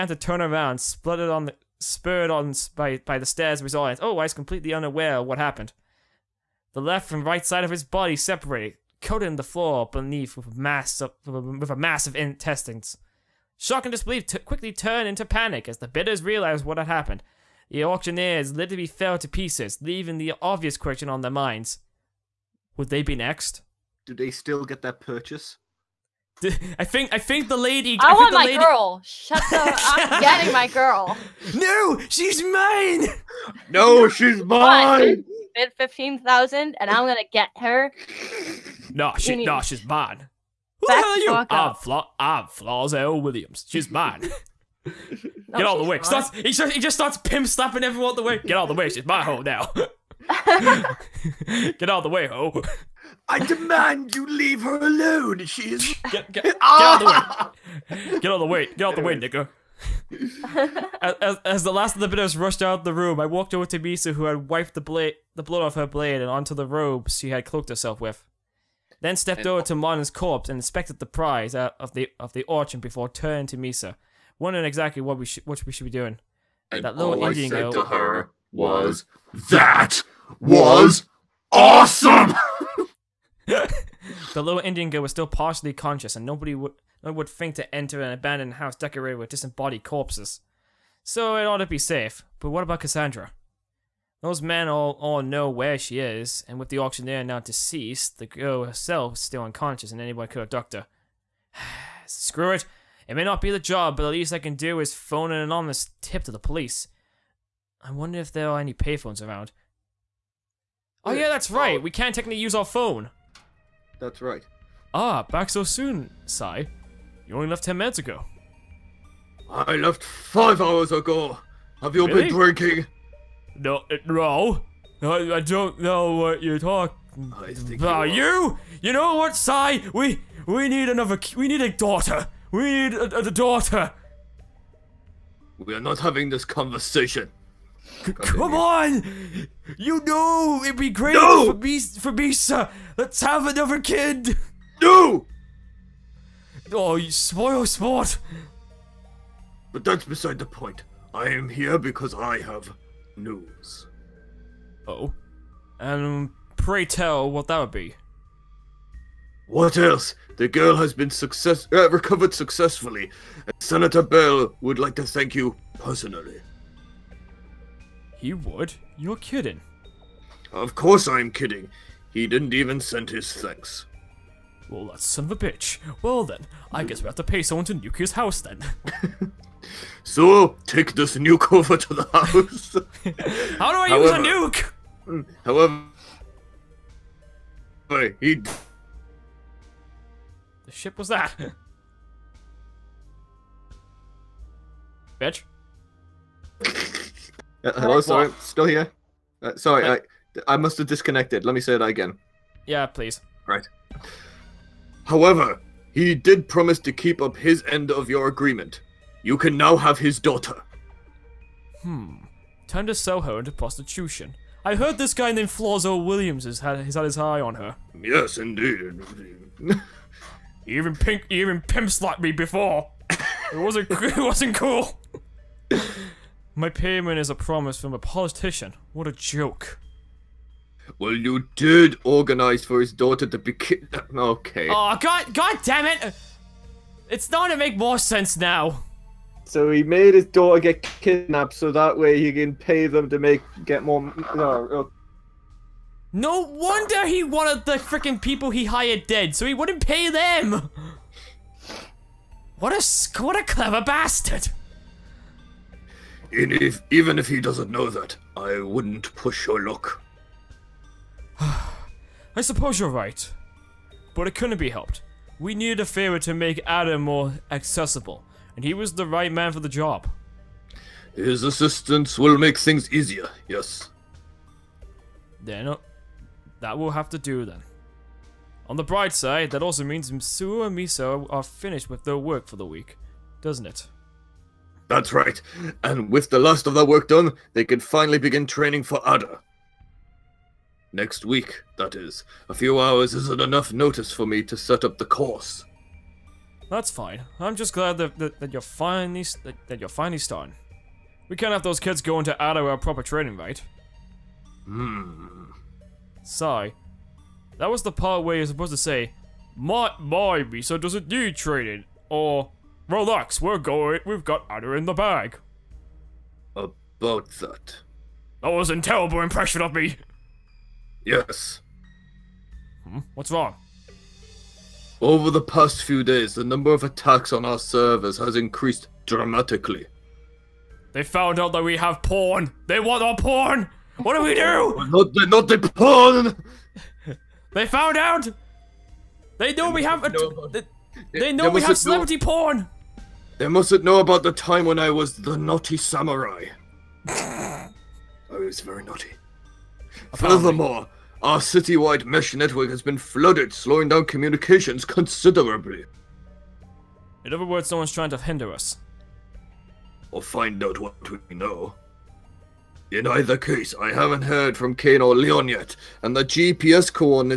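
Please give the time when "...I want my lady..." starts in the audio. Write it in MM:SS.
00:28.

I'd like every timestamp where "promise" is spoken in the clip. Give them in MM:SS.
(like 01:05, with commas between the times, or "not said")
03:26, 03:47.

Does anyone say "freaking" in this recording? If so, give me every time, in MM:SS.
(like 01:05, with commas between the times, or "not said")
04:07.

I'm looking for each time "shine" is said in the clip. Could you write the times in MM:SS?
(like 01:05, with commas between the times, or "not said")
not said.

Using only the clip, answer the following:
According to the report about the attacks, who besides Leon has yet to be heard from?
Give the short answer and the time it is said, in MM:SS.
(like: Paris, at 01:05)
Kane, at 06:04.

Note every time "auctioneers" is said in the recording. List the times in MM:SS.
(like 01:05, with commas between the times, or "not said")
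00:17, 01:36.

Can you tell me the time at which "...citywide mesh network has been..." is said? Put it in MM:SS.
05:51.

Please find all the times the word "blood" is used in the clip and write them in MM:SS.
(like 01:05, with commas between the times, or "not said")
01:05.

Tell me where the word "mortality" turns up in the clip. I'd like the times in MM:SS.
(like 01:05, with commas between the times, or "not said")
not said.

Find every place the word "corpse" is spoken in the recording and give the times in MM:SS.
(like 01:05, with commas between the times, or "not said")
01:10, 01:29.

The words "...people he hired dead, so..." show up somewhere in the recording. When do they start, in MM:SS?
04:08.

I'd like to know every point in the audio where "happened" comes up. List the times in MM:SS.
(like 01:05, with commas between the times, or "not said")
00:05, 00:16.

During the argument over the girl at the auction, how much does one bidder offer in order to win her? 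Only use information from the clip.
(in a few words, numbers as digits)
15,000.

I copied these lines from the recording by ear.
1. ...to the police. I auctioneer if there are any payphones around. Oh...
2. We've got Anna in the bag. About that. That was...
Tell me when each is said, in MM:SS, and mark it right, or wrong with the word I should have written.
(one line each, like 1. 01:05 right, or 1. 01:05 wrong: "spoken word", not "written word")
1. 01:46 wrong: "wonder", not "auctioneer"
2. 05:14 right.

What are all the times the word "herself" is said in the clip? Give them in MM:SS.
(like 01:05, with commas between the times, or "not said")
01:07, 01:38.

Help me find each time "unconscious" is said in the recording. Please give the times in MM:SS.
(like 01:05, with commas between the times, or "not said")
01:39.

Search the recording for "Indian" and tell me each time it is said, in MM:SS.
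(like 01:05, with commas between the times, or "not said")
01:17, 01:24.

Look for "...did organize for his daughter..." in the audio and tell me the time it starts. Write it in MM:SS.
03:51.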